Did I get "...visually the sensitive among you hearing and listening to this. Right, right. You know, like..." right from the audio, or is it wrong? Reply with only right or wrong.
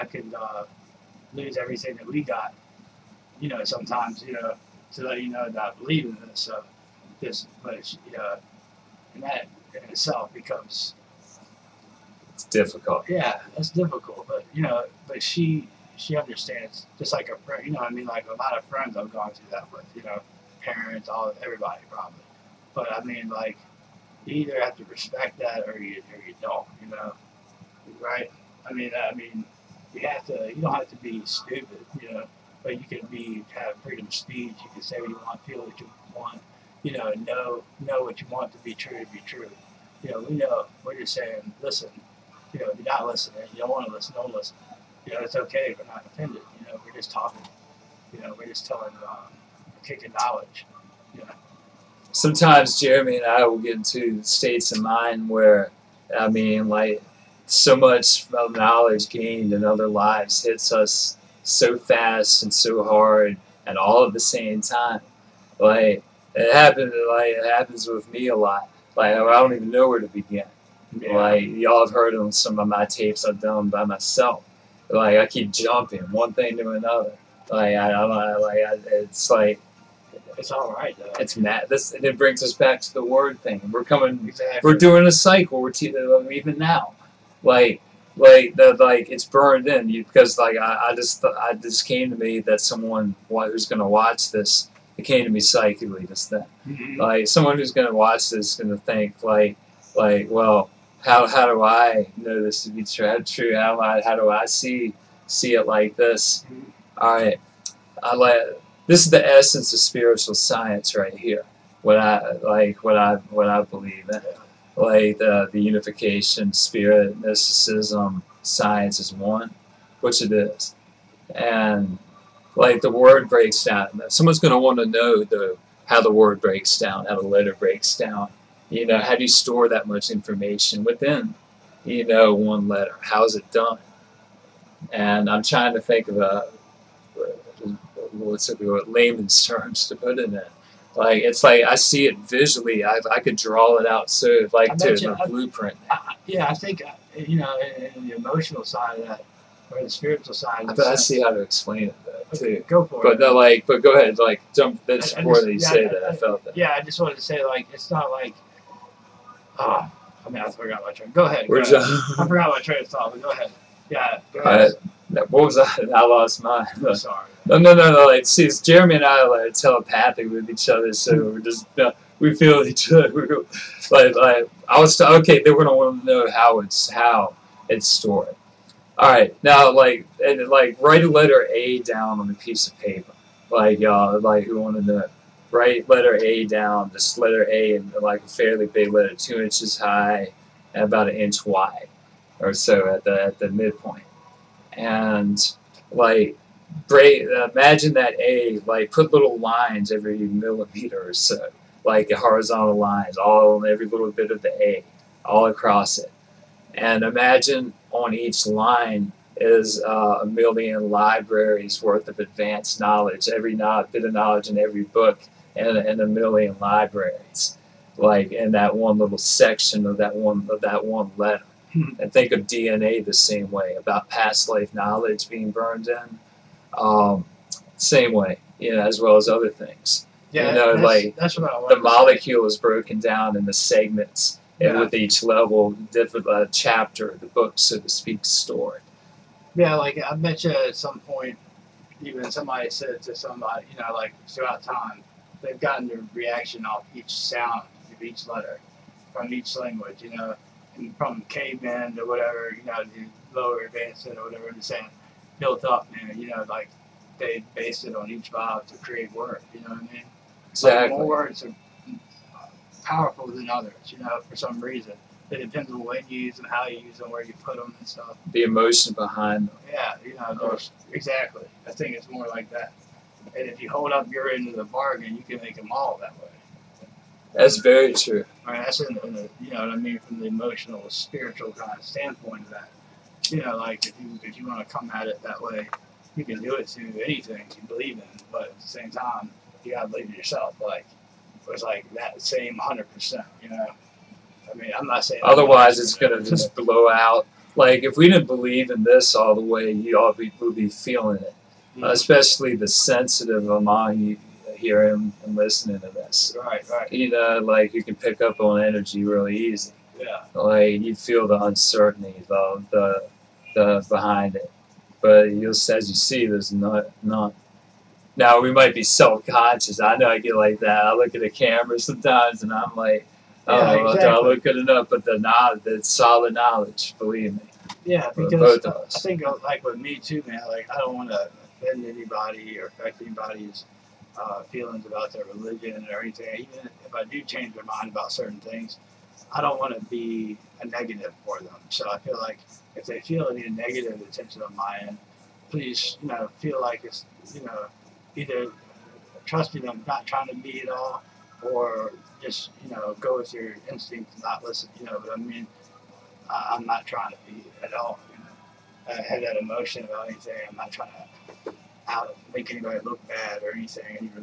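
wrong.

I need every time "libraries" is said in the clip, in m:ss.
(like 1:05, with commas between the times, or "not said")
3:30, 3:36.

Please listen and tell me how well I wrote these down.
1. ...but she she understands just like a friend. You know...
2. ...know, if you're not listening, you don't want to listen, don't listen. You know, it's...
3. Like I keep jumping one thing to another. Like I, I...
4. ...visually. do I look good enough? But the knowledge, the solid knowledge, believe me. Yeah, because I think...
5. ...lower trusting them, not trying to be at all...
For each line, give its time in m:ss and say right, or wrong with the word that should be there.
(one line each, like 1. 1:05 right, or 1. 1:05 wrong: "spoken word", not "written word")
1. 0:15 right
2. 0:42 right
3. 1:14 right
4. 5:23 wrong: "exactly", not "visually"
5. 5:48 wrong: "either", not "lower".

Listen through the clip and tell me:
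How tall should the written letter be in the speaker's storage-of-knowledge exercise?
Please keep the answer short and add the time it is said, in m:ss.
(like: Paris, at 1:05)
2 inches, at 3:09.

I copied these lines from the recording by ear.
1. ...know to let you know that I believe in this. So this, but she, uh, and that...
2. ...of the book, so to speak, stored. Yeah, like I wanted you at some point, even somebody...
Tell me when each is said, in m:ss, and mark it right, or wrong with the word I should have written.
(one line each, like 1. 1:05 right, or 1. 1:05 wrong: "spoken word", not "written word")
1. 0:04 right
2. 3:57 wrong: "mentioned", not "wanted".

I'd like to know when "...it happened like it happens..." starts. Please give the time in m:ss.
1:06.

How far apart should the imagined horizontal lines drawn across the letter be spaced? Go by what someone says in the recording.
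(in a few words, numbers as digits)
every millimeter.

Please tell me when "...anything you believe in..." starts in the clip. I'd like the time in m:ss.
4:47.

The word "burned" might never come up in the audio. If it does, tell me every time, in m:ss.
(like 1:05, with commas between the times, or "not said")
1:29, 3:45.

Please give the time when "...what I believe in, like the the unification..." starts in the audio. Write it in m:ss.
1:53.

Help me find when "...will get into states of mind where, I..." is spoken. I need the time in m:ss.
0:53.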